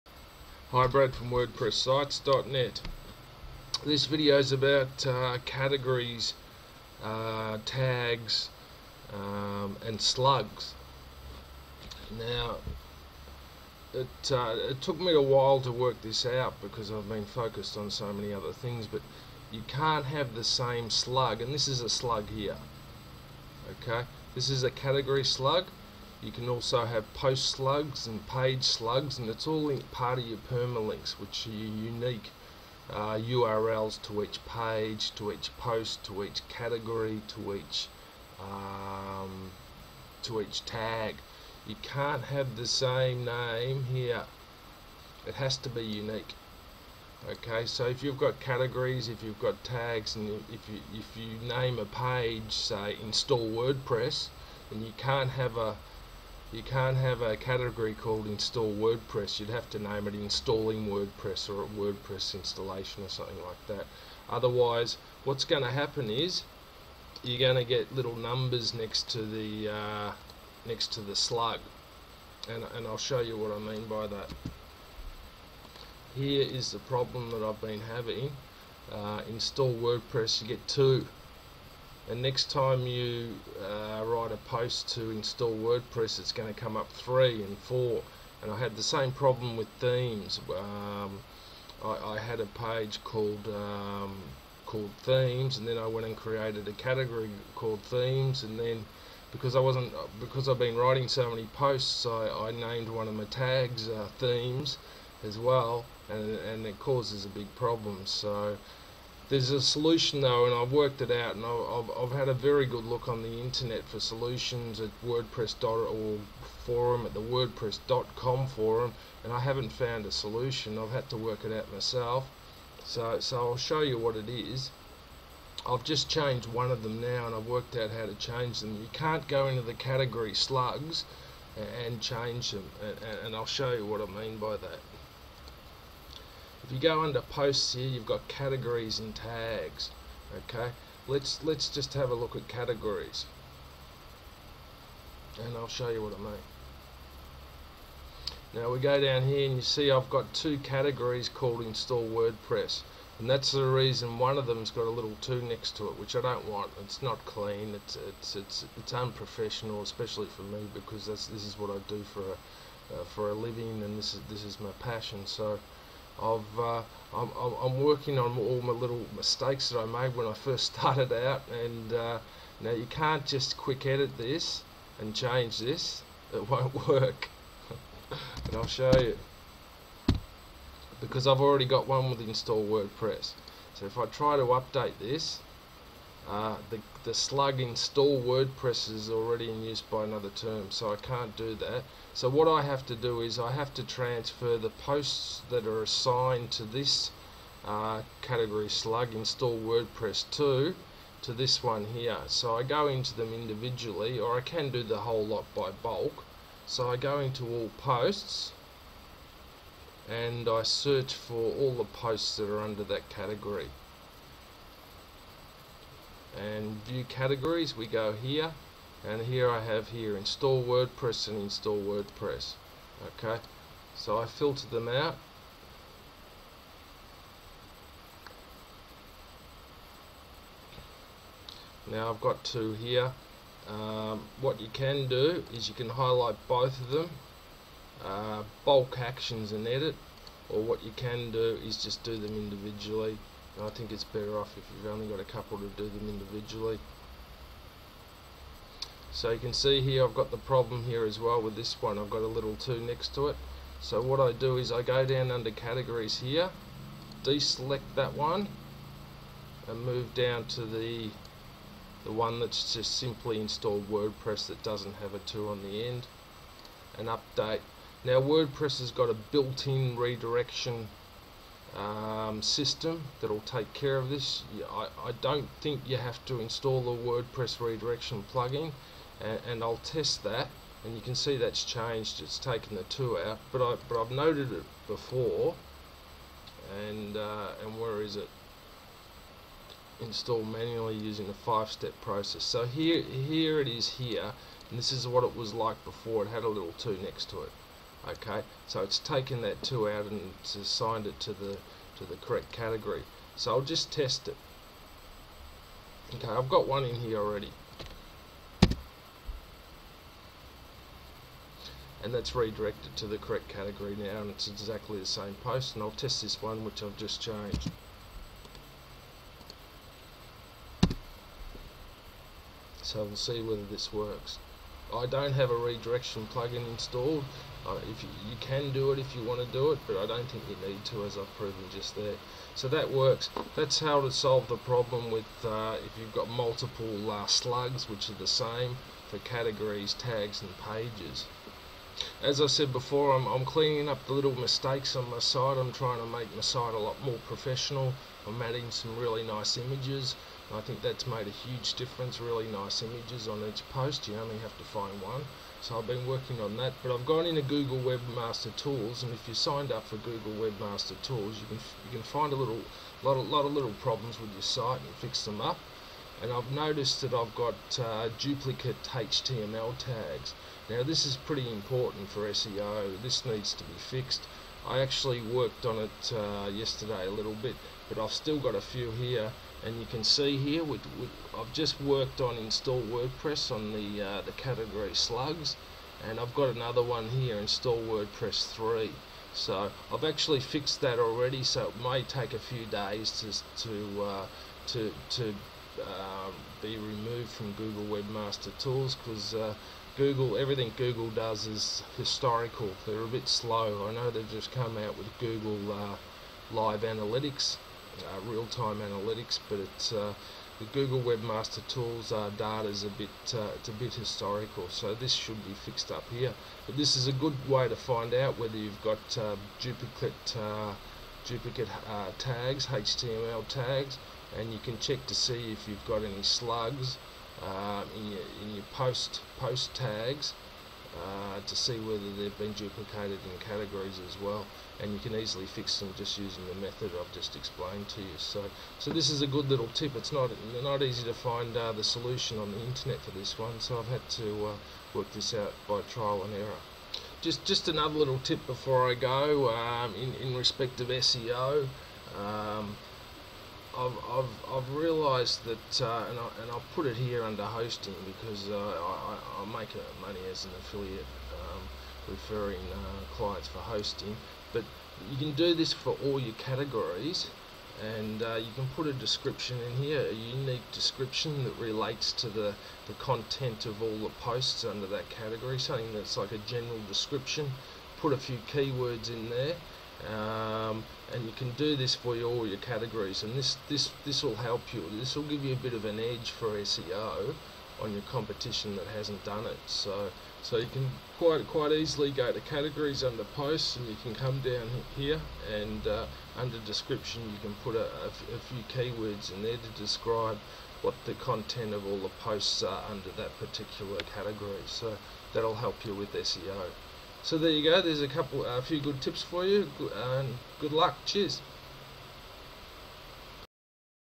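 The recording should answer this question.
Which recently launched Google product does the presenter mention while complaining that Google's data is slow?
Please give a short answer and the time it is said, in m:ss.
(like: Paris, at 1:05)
real-time analytics, at 6:48.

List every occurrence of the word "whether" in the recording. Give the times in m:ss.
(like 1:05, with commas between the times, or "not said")
5:23, 6:58, 7:11.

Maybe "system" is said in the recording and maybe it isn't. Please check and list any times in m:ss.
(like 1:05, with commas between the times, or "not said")
4:32.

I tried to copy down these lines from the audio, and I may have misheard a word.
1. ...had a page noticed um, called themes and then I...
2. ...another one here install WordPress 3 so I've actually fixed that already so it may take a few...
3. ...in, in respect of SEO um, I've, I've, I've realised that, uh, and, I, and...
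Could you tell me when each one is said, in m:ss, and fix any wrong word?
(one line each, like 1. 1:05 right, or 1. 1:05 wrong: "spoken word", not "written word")
1. 1:32 wrong: "called", not "noticed"
2. 6:26 right
3. 7:29 right.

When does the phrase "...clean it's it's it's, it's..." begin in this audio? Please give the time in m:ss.
2:37.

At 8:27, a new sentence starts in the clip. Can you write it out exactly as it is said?
There's a couple, a few good tips for you.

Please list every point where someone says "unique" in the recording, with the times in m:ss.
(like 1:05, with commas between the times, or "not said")
0:31, 0:45, 7:50.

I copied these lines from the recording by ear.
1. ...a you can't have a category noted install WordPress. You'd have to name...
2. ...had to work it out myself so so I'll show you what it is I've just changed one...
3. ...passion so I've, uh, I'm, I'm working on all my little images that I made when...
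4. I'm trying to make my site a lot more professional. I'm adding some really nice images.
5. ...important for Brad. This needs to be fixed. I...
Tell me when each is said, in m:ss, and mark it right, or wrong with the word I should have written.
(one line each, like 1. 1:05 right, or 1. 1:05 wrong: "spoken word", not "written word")
1. 0:55 wrong: "called", not "noted"
2. 2:00 right
3. 2:44 wrong: "mistakes", not "images"
4. 5:45 right
5. 6:11 wrong: "SEO", not "Brad".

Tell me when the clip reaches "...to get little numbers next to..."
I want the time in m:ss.
1:07.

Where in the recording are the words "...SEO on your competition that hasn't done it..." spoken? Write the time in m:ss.
8:06.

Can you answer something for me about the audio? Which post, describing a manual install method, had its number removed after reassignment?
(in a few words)
install manually using the five-step process.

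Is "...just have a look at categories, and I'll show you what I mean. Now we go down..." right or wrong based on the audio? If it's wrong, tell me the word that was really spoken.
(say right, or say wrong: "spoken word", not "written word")
right.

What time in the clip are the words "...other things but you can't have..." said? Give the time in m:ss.
0:18.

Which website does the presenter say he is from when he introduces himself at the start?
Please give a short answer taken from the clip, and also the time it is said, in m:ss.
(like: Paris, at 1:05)
WordPressSites.net, at 0:01.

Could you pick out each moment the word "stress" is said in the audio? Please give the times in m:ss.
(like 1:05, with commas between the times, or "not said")
not said.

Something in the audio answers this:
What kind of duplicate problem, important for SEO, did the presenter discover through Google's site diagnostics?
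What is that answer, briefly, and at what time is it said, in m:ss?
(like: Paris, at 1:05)
duplicate HTML tags, at 6:08.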